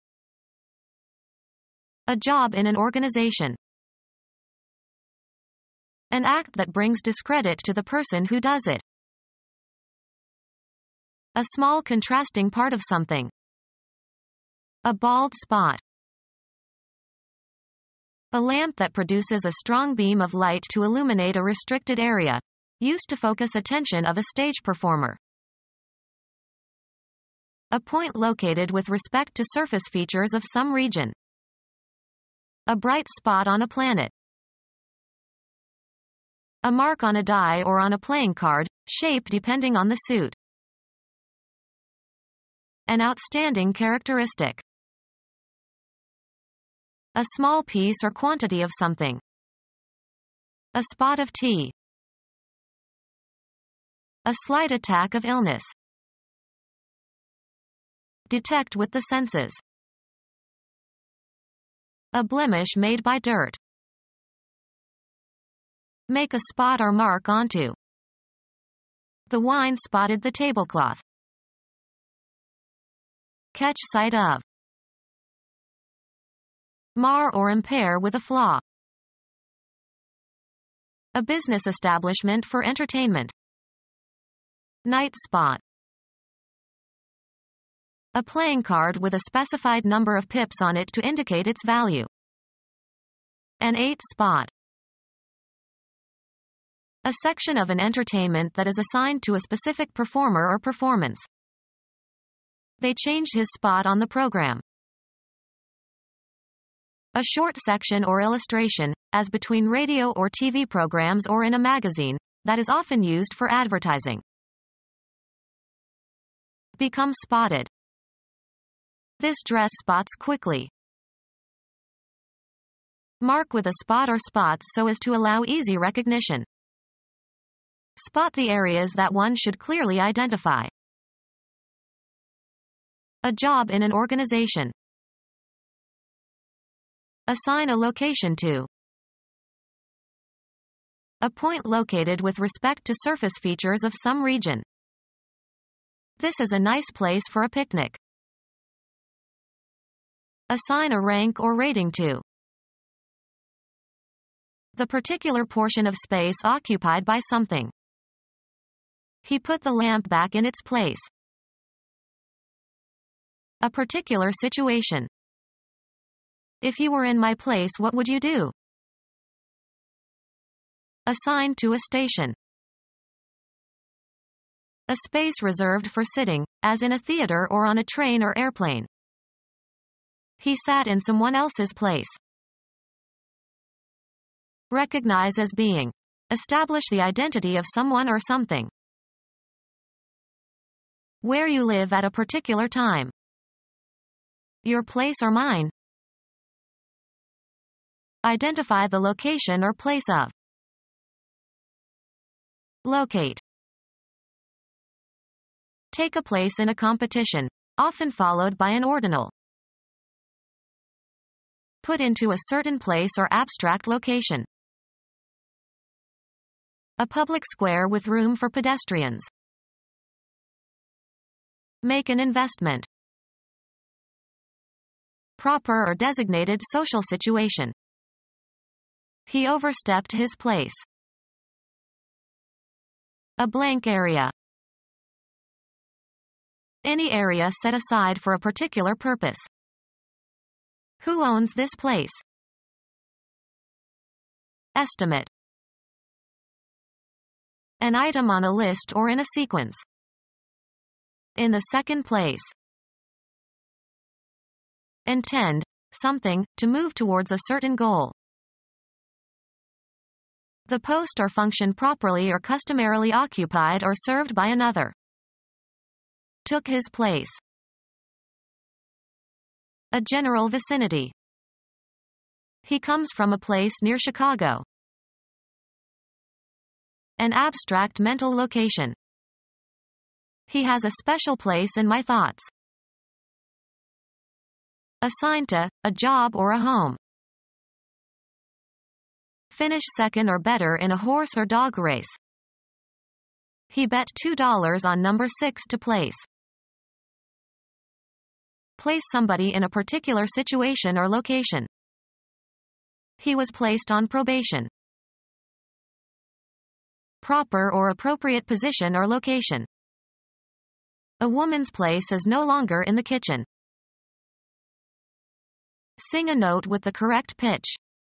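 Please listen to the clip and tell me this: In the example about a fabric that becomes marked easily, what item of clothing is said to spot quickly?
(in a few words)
dress.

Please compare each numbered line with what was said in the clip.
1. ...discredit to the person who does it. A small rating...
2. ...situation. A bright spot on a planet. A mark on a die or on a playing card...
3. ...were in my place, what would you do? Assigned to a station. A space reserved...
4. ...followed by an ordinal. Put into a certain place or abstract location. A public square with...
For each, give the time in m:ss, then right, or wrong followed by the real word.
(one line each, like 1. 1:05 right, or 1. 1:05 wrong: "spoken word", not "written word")
1. 0:07 wrong: "contrasting", not "rating"
2. 0:30 wrong: "region", not "situation"
3. 2:46 right
4. 3:28 right.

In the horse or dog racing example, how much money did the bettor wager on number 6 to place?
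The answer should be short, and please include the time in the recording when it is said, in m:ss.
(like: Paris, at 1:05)
$2, at 4:54.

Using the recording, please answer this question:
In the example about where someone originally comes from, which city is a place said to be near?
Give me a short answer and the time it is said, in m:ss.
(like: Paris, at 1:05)
Chicago, at 4:33.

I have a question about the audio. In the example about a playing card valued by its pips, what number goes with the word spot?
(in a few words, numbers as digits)
8.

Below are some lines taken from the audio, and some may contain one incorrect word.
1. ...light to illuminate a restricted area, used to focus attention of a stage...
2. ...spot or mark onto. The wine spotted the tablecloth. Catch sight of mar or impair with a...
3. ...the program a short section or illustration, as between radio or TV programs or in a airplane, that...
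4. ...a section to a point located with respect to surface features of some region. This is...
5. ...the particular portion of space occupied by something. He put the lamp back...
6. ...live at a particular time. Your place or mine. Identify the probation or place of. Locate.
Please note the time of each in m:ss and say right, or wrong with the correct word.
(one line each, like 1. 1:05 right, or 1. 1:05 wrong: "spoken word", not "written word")
1. 0:20 right
2. 1:06 right
3. 1:43 wrong: "magazine", not "airplane"
4. 2:17 wrong: "location", not "section"
5. 2:34 right
6. 3:11 wrong: "location", not "probation".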